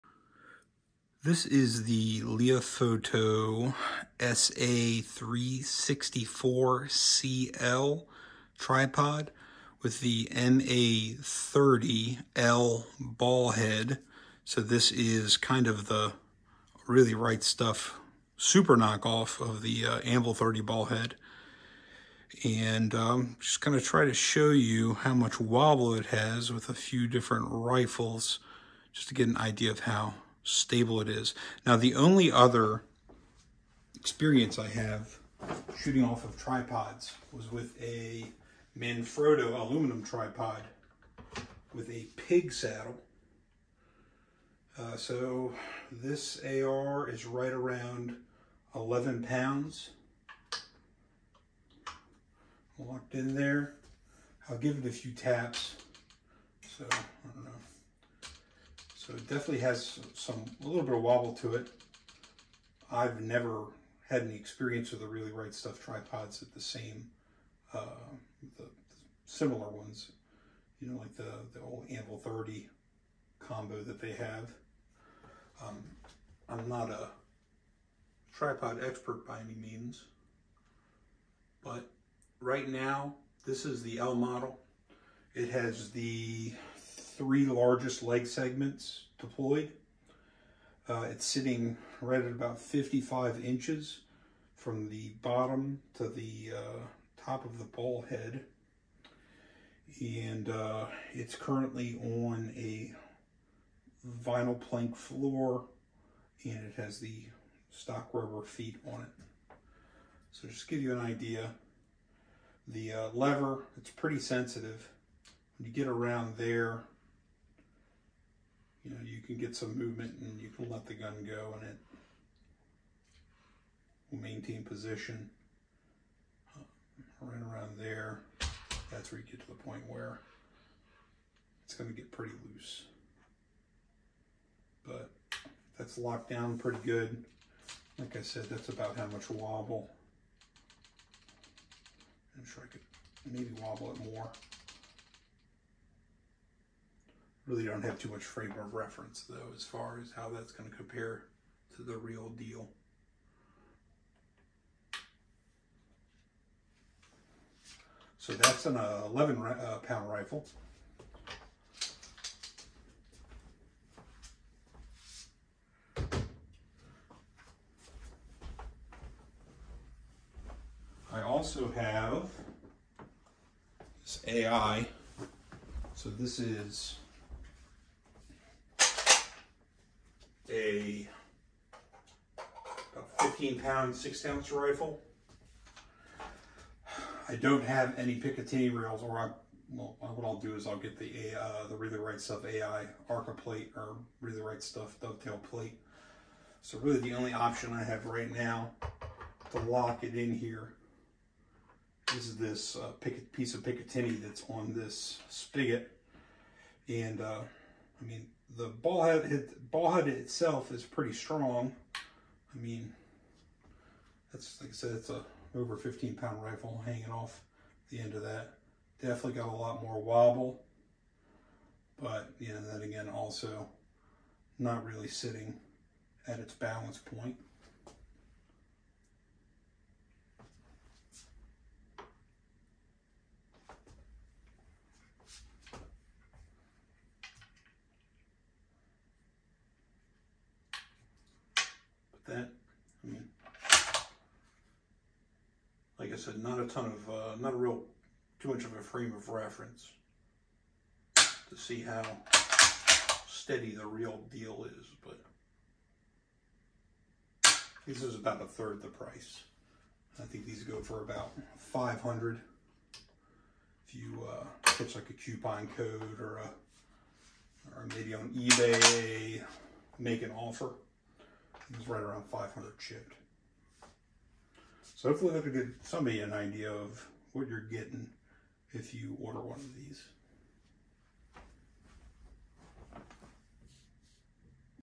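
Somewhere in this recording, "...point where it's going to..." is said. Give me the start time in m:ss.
2:09.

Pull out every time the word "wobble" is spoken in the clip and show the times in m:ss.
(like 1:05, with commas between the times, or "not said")
0:25, 1:01, 2:19, 2:23, 3:40.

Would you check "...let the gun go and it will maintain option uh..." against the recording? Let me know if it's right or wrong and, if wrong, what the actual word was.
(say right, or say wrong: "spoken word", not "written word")
wrong: "position", not "option".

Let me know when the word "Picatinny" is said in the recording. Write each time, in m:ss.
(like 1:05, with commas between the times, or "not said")
3:08, 3:23.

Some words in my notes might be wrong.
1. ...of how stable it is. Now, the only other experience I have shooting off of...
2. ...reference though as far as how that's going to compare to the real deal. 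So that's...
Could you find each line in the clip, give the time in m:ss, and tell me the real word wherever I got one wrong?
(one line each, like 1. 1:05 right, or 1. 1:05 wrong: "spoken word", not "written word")
1. 0:29 right
2. 2:28 right.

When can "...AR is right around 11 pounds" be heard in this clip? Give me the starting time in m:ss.
0:46.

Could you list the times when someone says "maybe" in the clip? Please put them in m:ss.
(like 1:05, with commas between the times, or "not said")
2:23, 4:27.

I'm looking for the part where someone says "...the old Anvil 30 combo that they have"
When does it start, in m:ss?
1:11.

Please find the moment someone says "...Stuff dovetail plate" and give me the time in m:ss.
3:14.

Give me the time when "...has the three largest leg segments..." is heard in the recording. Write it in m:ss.
1:25.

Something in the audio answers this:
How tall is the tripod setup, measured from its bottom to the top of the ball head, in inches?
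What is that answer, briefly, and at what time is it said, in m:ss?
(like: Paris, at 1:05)
55, at 1:32.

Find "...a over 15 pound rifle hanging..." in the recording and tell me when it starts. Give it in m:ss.
3:35.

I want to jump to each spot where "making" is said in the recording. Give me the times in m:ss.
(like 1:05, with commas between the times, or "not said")
not said.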